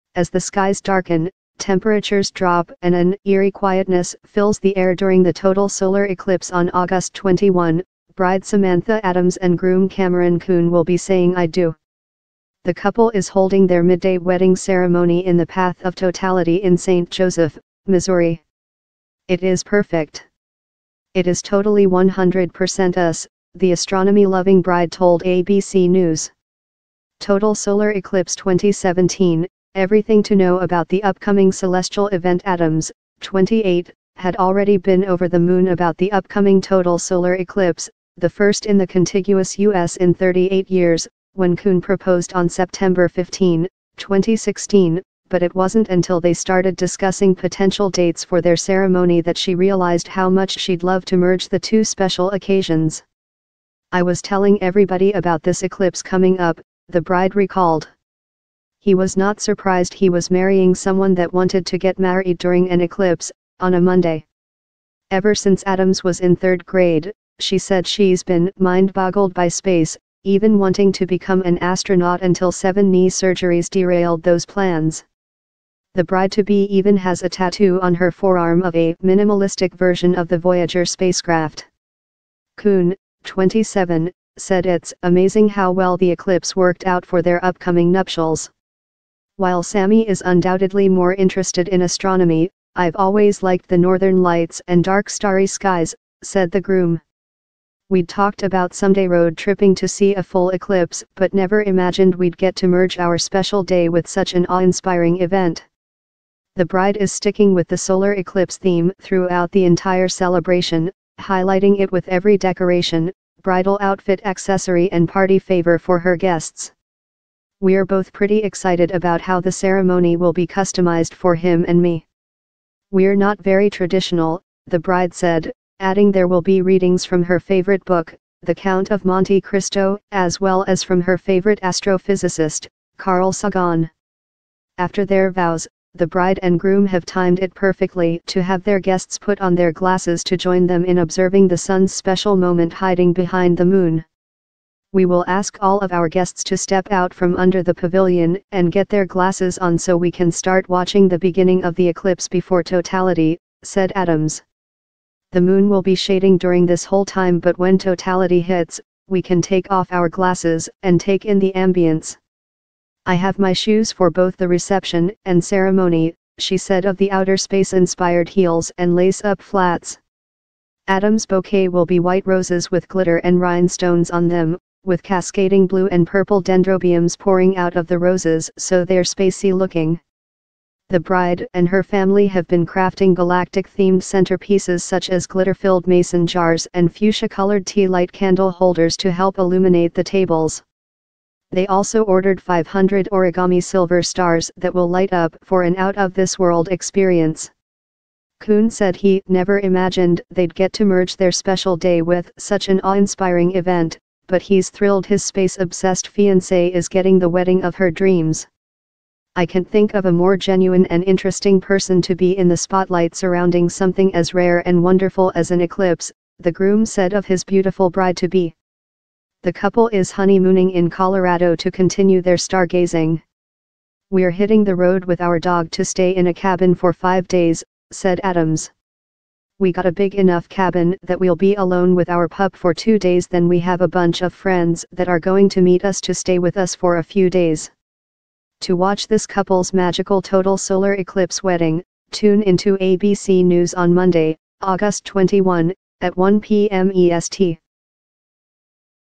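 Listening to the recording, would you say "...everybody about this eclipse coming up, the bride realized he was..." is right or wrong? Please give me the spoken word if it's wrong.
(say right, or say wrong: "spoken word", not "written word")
wrong: "recalled", not "realized".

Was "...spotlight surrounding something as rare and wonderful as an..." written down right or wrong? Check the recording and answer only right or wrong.
right.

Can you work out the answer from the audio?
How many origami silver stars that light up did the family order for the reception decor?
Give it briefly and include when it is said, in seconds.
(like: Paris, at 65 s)
500, at 192 s.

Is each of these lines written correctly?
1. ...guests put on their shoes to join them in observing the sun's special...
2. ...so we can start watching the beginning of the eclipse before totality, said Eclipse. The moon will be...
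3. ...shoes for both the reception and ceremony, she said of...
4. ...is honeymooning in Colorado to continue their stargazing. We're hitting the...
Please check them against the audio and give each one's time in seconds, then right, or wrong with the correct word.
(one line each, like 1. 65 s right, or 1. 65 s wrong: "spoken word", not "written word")
1. 138 s wrong: "glasses", not "shoes"
2. 149 s wrong: "Adams", not "Eclipse"
3. 163 s right
4. 219 s right.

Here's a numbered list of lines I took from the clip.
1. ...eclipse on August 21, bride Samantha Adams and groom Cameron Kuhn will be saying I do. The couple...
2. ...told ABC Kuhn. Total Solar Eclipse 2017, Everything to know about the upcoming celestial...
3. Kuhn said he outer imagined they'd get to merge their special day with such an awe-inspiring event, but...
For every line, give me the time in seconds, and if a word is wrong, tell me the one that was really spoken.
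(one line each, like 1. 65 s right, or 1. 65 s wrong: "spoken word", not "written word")
1. 6 s right
2. 24 s wrong: "News", not "Kuhn"
3. 198 s wrong: "never", not "outer".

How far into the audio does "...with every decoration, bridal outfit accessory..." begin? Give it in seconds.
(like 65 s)
111 s.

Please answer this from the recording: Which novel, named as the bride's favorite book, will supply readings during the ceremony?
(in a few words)
The Count of Monte Cristo.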